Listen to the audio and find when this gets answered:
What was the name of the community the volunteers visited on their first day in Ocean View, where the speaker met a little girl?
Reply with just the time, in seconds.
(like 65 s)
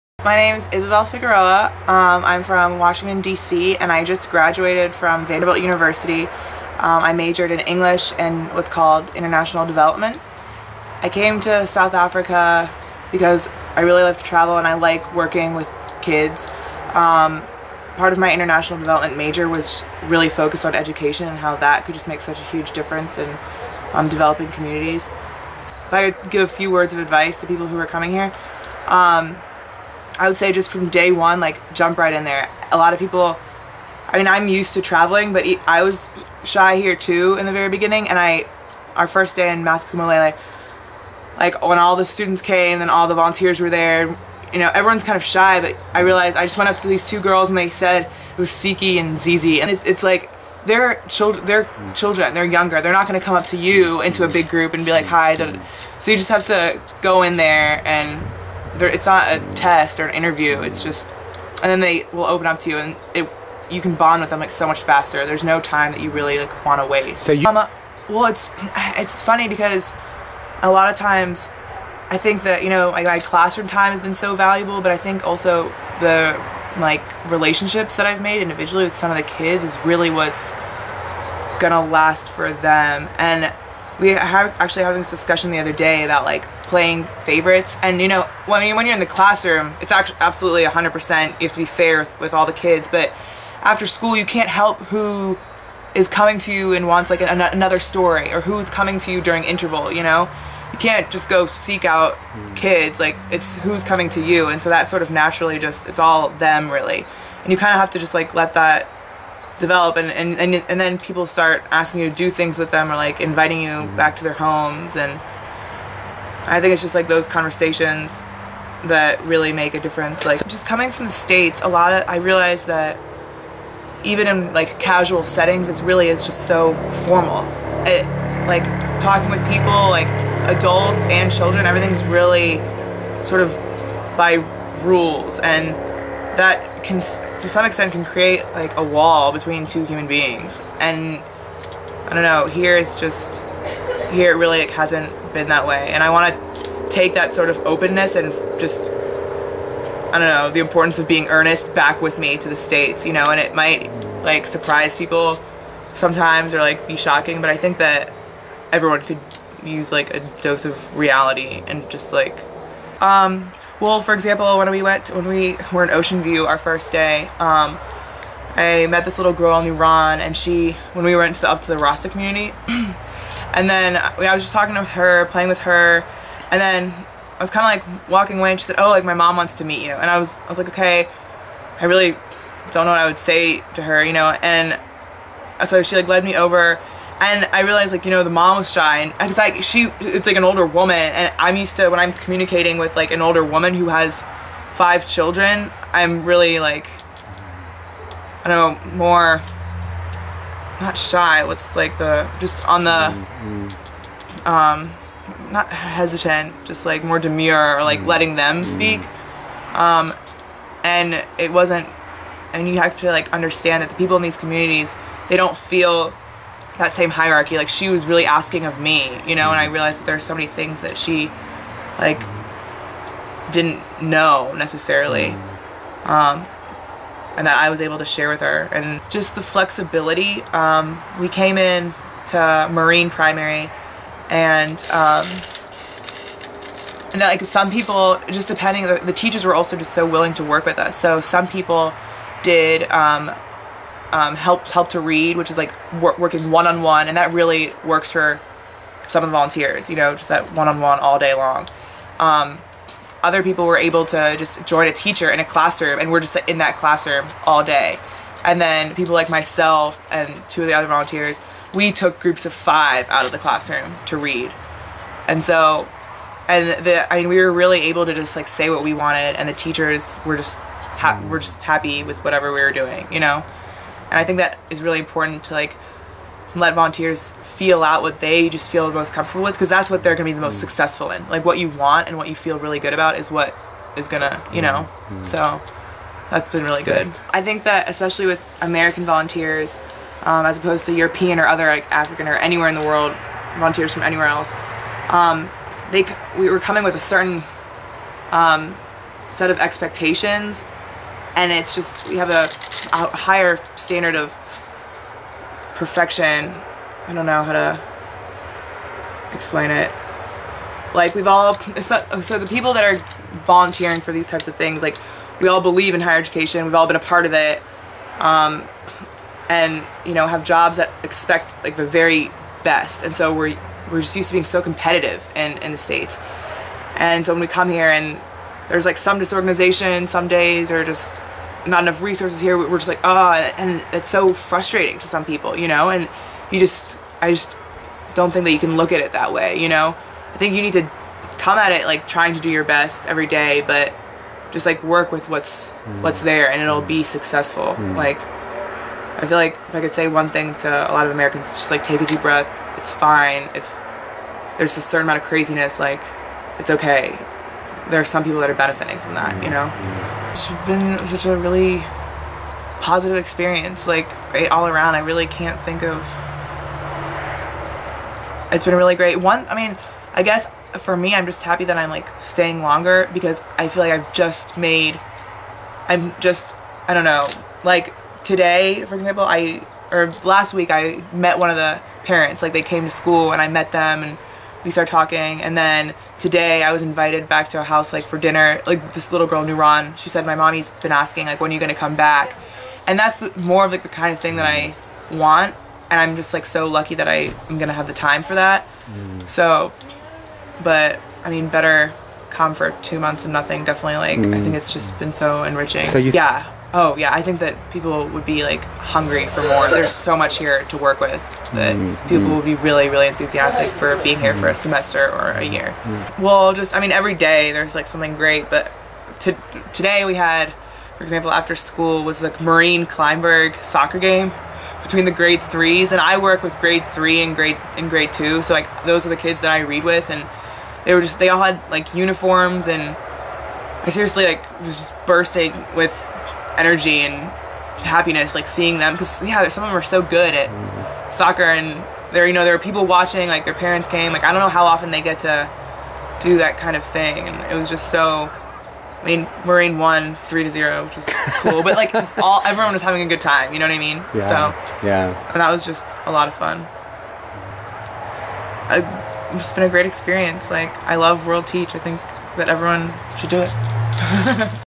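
171 s.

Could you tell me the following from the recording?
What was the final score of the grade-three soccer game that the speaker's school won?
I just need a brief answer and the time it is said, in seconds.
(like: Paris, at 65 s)
3-0, at 450 s.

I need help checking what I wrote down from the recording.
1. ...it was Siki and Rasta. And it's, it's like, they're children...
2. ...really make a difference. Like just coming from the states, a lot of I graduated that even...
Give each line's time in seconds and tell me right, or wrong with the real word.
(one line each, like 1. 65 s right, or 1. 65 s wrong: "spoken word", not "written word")
1. 48 s wrong: "Zizi", not "Rasta"
2. 119 s wrong: "realized", not "graduated".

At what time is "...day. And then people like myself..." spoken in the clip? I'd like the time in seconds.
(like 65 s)
257 s.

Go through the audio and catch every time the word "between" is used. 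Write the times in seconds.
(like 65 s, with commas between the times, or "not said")
139 s, 424 s.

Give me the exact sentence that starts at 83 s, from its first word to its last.
And we have actually having this discussion the other day about like playing favorites.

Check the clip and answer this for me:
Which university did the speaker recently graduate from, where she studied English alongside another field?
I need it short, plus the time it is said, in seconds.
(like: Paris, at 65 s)
Vanderbilt University, at 5 s.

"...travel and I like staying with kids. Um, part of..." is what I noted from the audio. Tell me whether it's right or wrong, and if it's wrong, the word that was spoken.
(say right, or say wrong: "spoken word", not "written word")
wrong: "working", not "staying".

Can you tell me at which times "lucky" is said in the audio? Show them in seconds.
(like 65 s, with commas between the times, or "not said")
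396 s.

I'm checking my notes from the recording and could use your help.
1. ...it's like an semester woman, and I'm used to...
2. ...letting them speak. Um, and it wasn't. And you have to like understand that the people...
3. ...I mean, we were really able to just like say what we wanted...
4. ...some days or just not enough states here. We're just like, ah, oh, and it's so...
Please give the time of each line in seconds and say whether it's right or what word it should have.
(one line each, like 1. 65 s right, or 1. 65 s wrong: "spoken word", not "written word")
1. 189 s wrong: "older", not "semester"
2. 208 s right
3. 267 s right
4. 330 s wrong: "resources", not "states".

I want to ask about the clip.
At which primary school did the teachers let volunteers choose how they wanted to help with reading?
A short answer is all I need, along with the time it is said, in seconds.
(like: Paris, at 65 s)
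Marine Primary, at 232 s.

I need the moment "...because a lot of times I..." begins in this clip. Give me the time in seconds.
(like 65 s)
69 s.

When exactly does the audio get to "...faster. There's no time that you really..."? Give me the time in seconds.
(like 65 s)
64 s.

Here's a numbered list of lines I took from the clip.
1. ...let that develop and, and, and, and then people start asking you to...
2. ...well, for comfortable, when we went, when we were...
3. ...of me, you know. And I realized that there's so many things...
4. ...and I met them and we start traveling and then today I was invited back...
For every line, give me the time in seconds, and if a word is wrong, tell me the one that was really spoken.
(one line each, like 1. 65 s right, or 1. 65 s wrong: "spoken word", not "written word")
1. 108 s right
2. 163 s wrong: "example", not "comfortable"
3. 218 s right
4. 383 s wrong: "talking", not "traveling".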